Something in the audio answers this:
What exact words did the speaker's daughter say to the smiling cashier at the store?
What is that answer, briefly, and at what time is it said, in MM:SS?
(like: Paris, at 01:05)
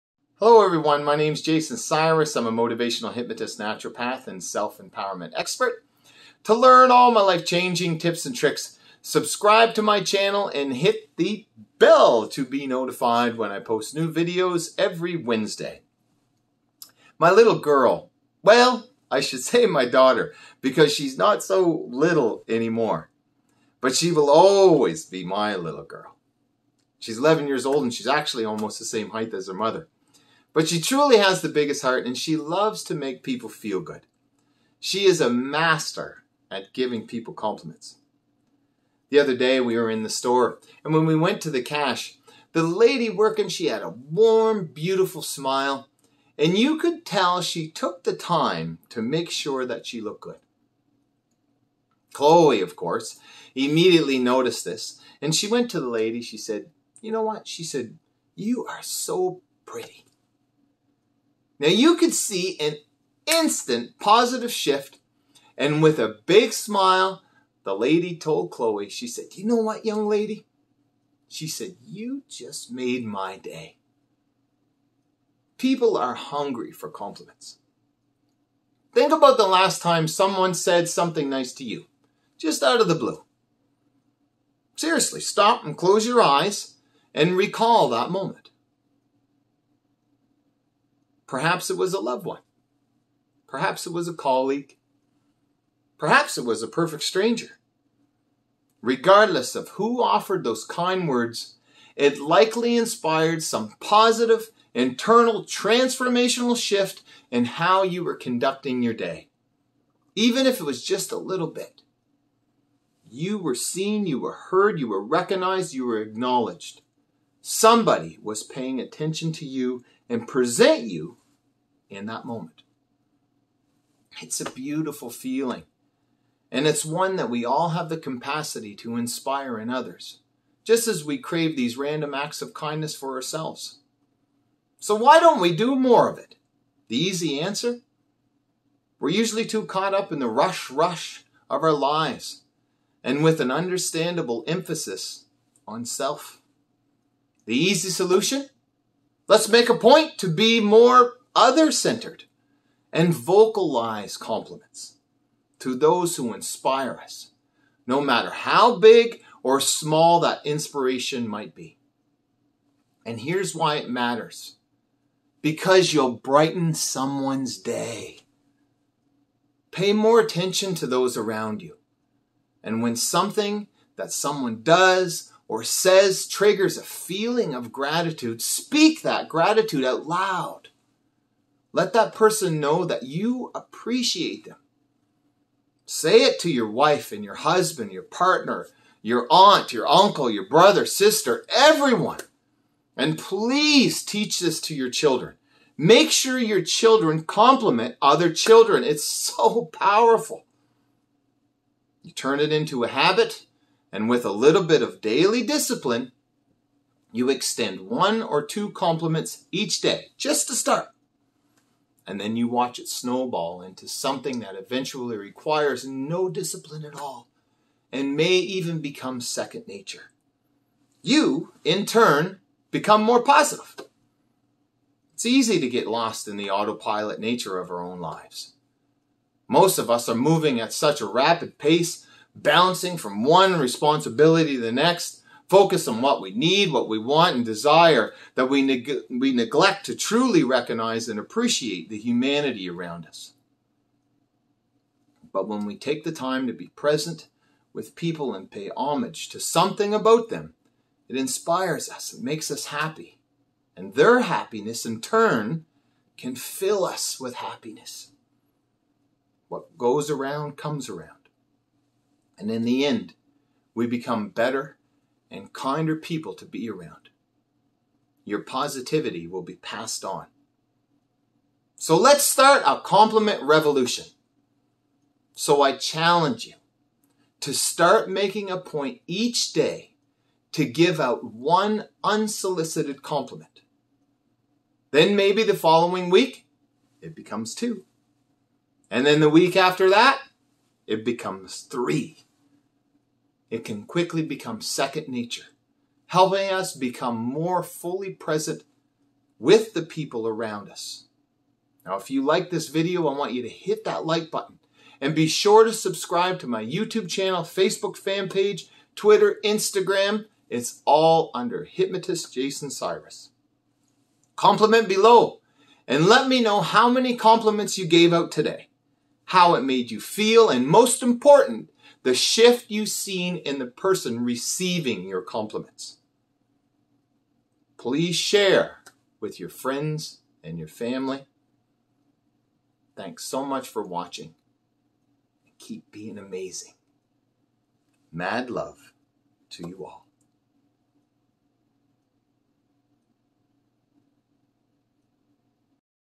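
You are so pretty, at 00:58.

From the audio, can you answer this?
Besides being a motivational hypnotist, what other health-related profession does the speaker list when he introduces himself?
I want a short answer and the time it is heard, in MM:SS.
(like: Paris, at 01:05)
Naturopath, at 00:03.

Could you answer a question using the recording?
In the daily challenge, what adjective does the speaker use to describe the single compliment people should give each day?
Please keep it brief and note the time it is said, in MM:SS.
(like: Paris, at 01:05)
Unsolicited, at 04:42.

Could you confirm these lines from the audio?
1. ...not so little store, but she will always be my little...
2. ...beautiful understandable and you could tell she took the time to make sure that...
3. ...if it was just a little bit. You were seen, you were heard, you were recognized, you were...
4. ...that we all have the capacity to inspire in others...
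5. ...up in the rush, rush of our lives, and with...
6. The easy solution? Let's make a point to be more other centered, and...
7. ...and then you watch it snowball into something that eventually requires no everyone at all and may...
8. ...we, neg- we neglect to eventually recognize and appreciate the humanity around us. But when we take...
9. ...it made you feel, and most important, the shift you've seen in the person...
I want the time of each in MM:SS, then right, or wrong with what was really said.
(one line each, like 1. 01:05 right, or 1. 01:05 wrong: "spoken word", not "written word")
1. 00:21 wrong: "anymore", not "store"
2. 00:44 wrong: "smile", not "understandable"
3. 01:50 right
4. 02:07 right
5. 02:19 right
6. 02:27 right
7. 03:32 wrong: "discipline", not "everyone"
8. 03:58 wrong: "truly", not "eventually"
9. 05:19 right.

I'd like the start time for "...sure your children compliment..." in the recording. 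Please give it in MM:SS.
03:16.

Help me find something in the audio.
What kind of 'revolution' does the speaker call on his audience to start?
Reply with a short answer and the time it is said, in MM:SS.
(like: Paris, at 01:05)
Compliment revolution, at 04:32.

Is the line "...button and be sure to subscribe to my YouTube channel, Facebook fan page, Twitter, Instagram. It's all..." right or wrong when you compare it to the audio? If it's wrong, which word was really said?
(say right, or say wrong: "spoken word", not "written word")
right.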